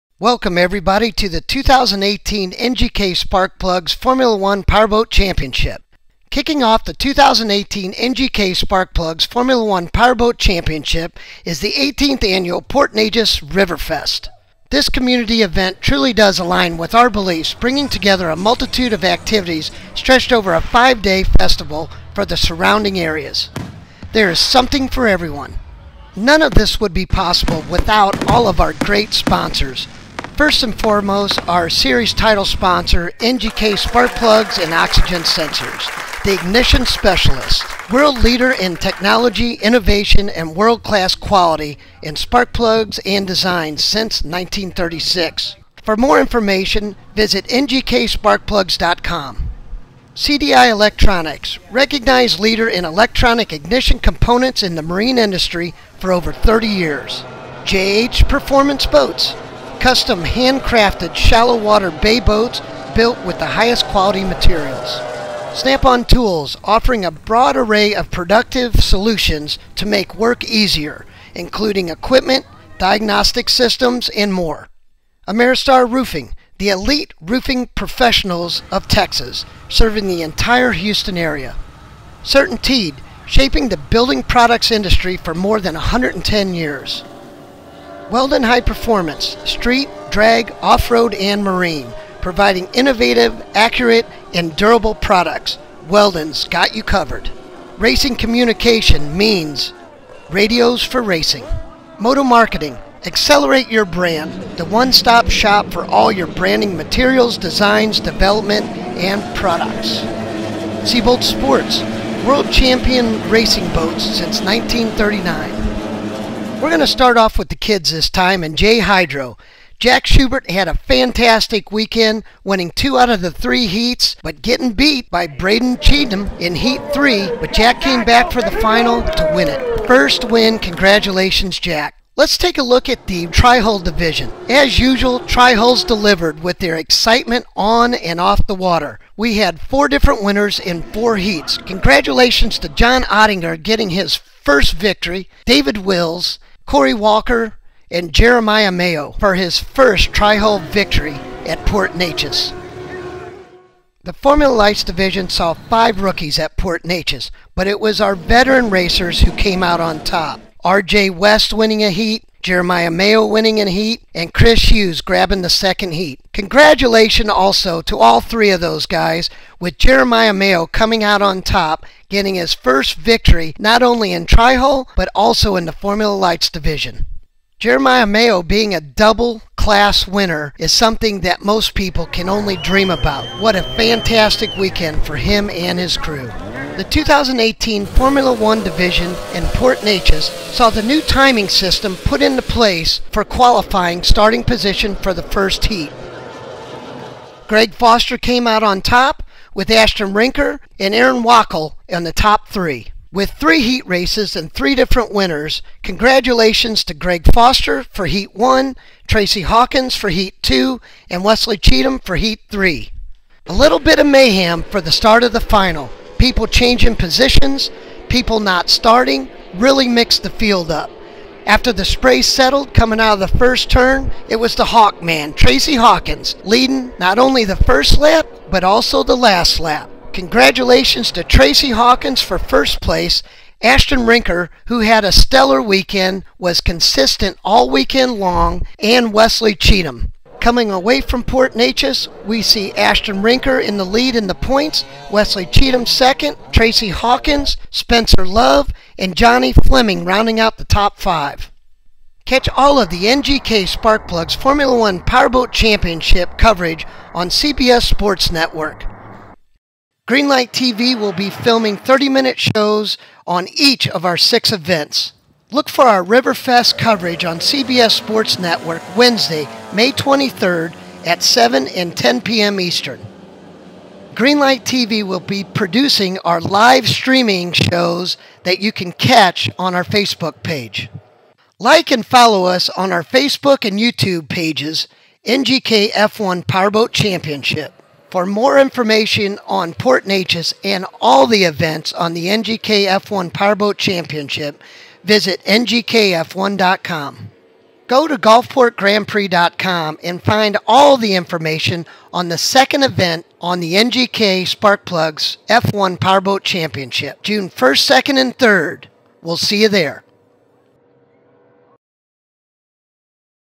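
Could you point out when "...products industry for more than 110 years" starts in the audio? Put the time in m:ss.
1:24.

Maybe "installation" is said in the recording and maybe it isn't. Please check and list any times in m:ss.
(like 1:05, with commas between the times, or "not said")
not said.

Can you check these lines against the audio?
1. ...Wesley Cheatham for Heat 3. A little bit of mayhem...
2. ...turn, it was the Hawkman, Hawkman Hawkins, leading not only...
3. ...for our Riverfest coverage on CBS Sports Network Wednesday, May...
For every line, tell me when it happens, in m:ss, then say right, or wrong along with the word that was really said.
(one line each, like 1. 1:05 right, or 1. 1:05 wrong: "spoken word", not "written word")
1. 3:31 right
2. 3:43 wrong: "Tracy", not "Hawkman"
3. 4:25 right.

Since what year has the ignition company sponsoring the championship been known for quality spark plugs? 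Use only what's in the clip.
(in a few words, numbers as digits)
1936.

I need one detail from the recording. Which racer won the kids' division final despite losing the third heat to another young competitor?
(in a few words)
Jack Schubert.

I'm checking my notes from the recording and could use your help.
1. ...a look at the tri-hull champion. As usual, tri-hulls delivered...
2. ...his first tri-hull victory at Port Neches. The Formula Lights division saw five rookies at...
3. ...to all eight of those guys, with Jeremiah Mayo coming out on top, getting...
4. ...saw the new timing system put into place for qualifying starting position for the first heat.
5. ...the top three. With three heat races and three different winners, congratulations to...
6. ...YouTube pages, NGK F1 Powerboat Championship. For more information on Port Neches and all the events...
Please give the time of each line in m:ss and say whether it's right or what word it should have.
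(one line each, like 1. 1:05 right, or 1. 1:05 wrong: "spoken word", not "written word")
1. 2:12 wrong: "division", not "champion"
2. 2:29 right
3. 2:47 wrong: "three", not "eight"
4. 3:10 right
5. 3:22 right
6. 4:43 right.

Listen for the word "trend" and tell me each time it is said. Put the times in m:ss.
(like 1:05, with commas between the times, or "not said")
not said.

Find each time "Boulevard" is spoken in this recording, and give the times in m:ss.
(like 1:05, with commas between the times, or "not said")
not said.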